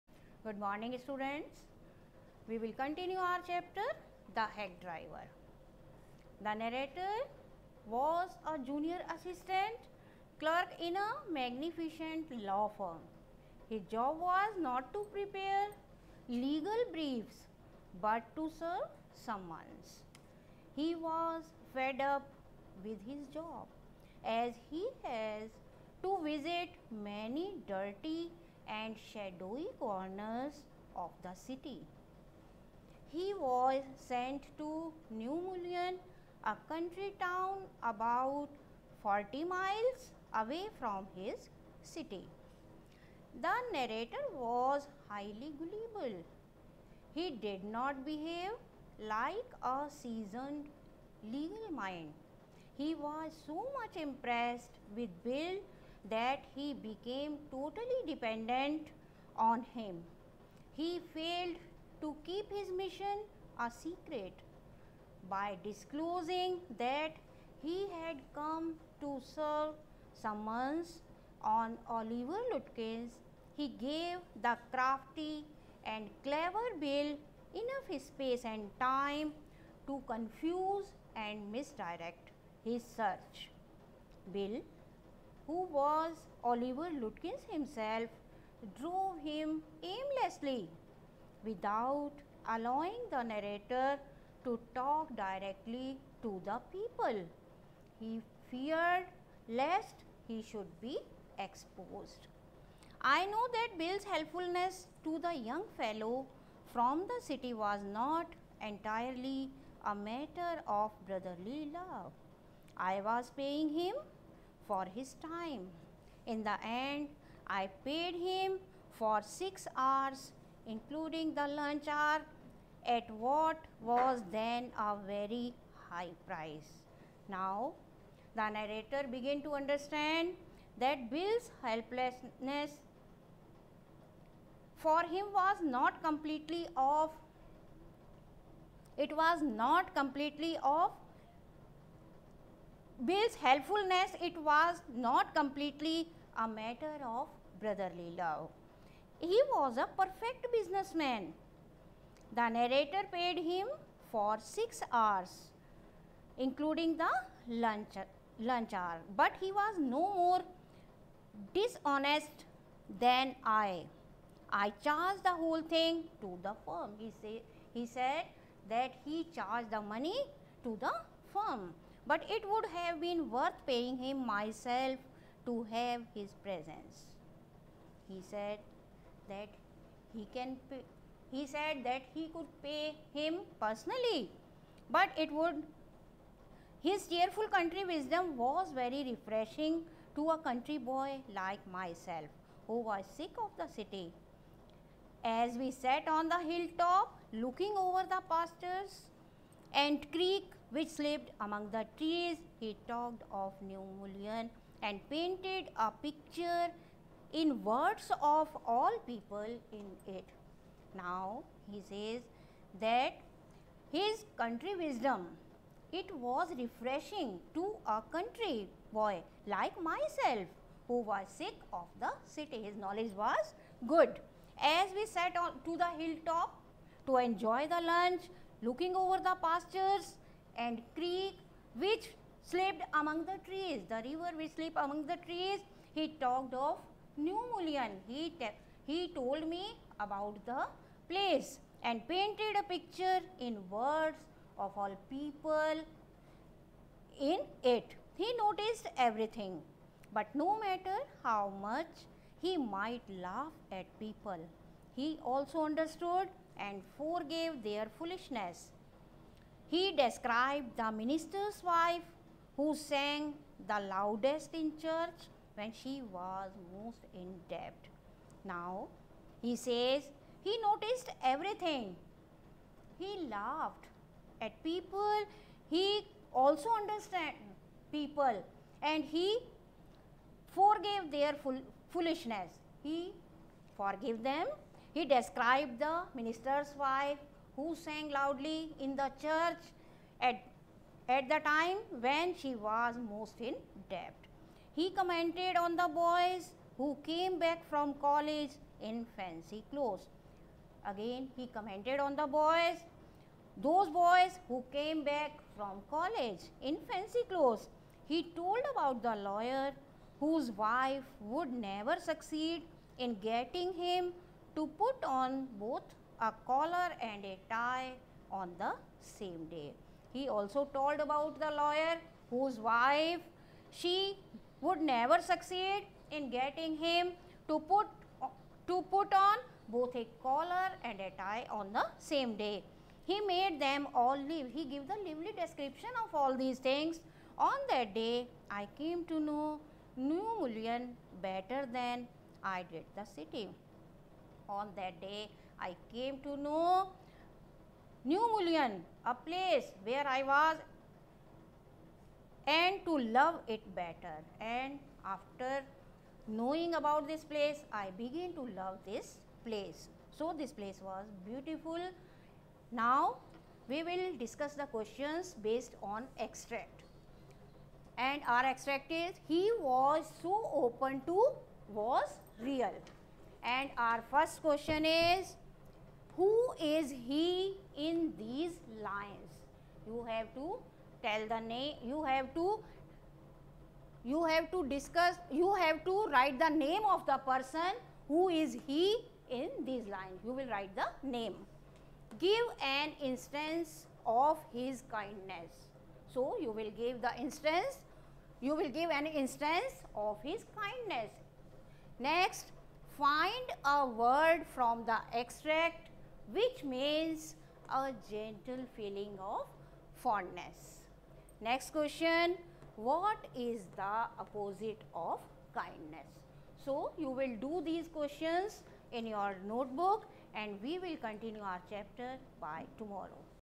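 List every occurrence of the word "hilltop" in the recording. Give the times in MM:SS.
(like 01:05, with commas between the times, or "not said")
03:16, 03:45.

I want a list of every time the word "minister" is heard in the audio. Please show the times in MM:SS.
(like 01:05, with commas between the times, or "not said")
04:20, 04:46.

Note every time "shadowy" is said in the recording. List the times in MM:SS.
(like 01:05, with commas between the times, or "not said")
00:29.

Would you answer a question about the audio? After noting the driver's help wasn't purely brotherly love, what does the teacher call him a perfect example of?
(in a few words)
Businessman.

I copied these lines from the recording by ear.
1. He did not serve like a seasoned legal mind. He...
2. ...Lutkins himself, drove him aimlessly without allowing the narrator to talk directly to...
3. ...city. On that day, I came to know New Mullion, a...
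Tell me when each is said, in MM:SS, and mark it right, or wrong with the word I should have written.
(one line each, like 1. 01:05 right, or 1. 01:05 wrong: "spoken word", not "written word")
1. 00:47 wrong: "behave", not "serve"
2. 01:27 right
3. 05:43 right.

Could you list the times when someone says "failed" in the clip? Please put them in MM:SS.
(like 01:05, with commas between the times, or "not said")
01:01.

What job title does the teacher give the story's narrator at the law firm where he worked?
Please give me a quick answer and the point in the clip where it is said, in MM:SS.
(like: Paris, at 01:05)
Junior assistant clerk, at 00:08.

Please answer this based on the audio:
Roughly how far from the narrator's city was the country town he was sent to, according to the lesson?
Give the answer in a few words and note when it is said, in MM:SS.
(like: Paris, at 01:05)
40 miles, at 00:39.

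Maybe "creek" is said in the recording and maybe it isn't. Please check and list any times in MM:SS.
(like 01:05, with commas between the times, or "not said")
03:20, 03:50.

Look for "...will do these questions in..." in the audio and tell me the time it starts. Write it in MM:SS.
06:57.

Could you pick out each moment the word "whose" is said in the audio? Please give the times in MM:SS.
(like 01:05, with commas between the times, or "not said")
05:10, 05:22.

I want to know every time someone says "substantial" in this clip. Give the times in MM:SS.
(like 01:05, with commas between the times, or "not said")
not said.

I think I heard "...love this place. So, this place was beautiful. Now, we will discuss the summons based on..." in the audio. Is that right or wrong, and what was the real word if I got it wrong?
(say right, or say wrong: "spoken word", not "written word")
wrong: "questions", not "summons".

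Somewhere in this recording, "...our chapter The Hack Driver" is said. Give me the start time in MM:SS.
00:03.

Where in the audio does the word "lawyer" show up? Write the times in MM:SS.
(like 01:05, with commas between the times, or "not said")
05:09, 05:21.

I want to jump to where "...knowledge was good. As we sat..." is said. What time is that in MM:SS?
03:42.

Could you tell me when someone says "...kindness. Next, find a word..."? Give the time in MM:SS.
06:40.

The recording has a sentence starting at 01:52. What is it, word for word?
I was paying him for his time.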